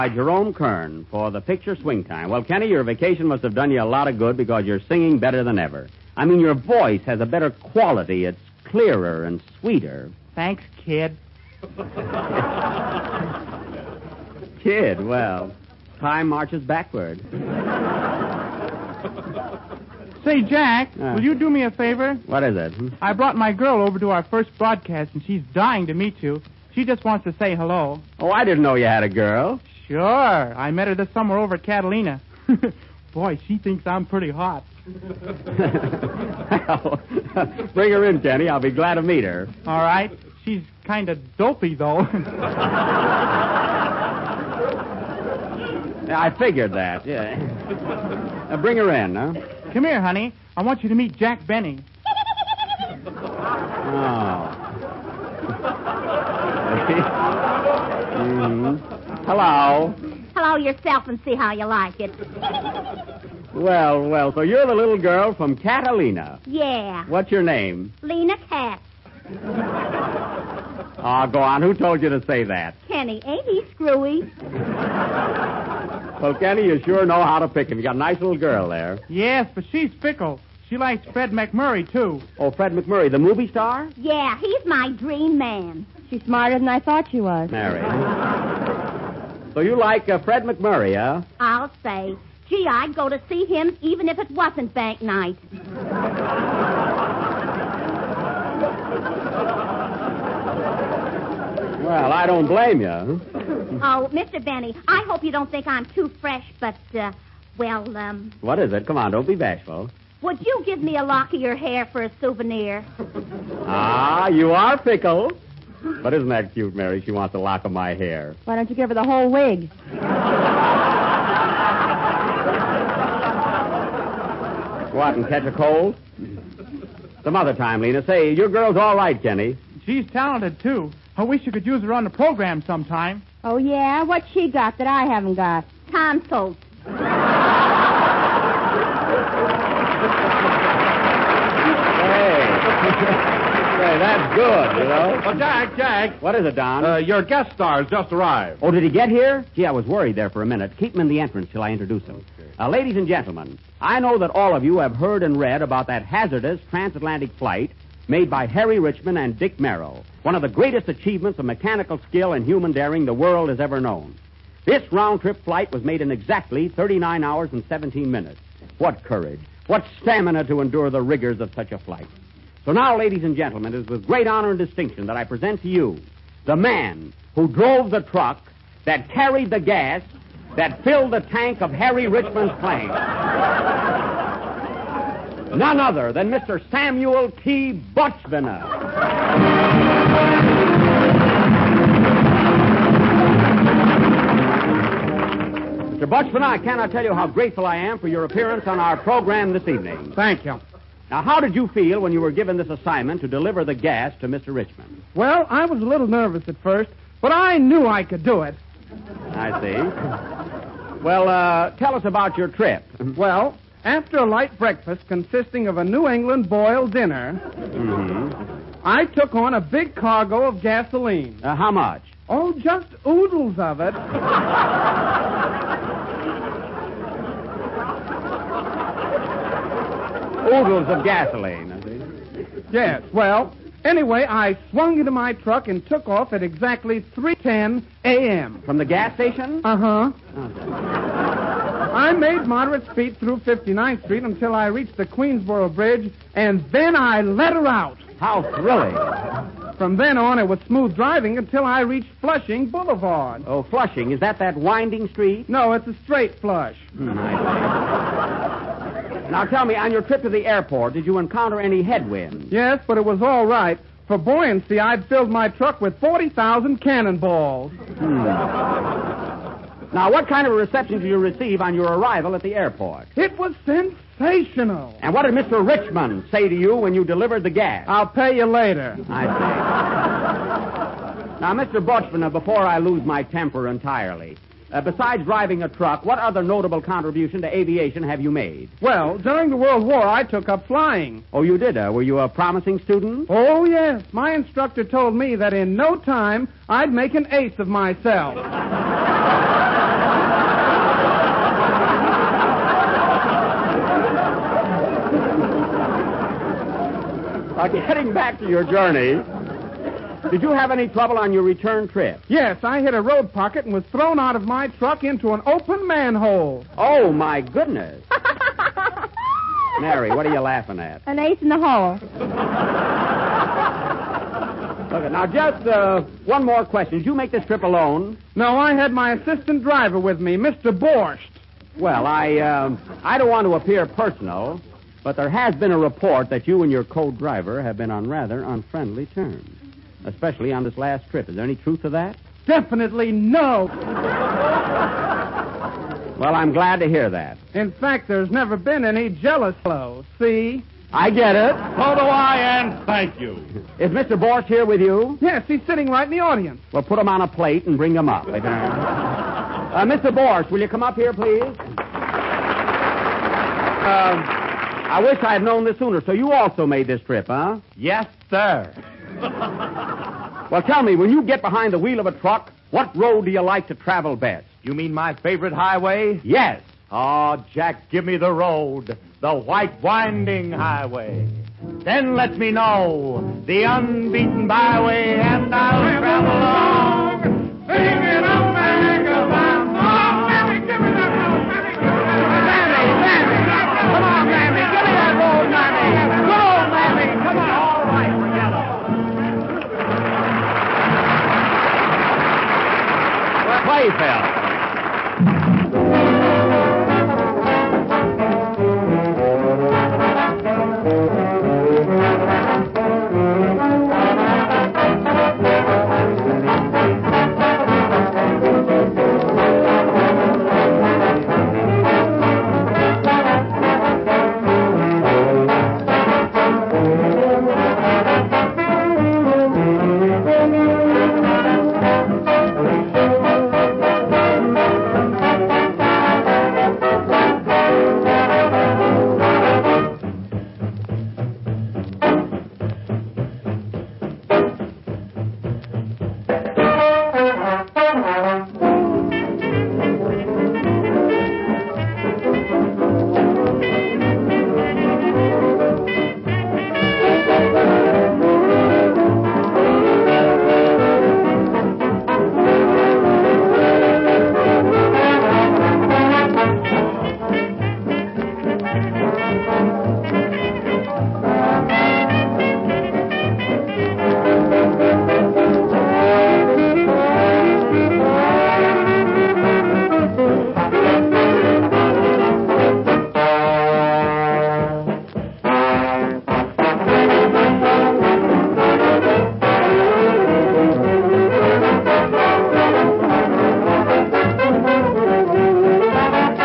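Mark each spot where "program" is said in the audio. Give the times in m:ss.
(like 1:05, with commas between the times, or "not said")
2:12, 3:19.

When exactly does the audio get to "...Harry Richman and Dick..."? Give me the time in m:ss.
2:38.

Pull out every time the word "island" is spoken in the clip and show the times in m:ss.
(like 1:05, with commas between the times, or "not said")
not said.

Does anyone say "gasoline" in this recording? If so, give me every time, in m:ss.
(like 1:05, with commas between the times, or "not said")
3:40, 3:51.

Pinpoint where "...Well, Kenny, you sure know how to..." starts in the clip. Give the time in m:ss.
1:16.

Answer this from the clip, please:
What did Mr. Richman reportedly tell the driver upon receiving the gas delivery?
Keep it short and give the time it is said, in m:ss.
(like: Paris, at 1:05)
I'll pay you later, at 4:37.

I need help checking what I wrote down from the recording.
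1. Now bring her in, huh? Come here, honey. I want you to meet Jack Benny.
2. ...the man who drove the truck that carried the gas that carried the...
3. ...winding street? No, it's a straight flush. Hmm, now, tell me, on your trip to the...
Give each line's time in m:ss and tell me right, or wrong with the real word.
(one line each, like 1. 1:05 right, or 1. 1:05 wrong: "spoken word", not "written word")
1. 0:48 right
2. 2:56 wrong: "filled", not "carried"
3. 4:14 right.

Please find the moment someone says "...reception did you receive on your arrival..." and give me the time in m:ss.
4:30.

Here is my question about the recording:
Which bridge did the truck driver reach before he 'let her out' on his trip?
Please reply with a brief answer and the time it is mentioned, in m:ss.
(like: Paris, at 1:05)
Queensboro Bridge, at 4:05.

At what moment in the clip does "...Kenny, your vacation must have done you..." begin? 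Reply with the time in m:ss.
0:02.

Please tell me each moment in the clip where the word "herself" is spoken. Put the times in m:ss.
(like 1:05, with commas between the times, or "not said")
not said.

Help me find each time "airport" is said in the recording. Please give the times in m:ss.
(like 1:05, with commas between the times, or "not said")
4:20, 4:32.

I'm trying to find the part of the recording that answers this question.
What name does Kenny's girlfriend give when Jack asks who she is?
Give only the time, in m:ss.
1:08.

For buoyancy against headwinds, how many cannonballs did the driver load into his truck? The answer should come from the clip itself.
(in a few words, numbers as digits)
40,000.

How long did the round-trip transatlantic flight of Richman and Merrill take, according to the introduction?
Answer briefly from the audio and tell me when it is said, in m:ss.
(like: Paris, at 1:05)
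39 hours and 17 minutes, at 2:46.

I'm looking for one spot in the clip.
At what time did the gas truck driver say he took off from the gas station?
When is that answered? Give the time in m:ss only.
3:57.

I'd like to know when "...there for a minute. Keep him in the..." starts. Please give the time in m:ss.
2:30.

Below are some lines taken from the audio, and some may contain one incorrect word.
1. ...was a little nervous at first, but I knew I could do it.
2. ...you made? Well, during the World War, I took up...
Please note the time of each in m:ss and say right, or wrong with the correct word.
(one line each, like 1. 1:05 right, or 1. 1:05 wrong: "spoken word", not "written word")
1. 3:25 right
2. 4:48 right.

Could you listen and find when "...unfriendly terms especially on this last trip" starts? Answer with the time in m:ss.
5:38.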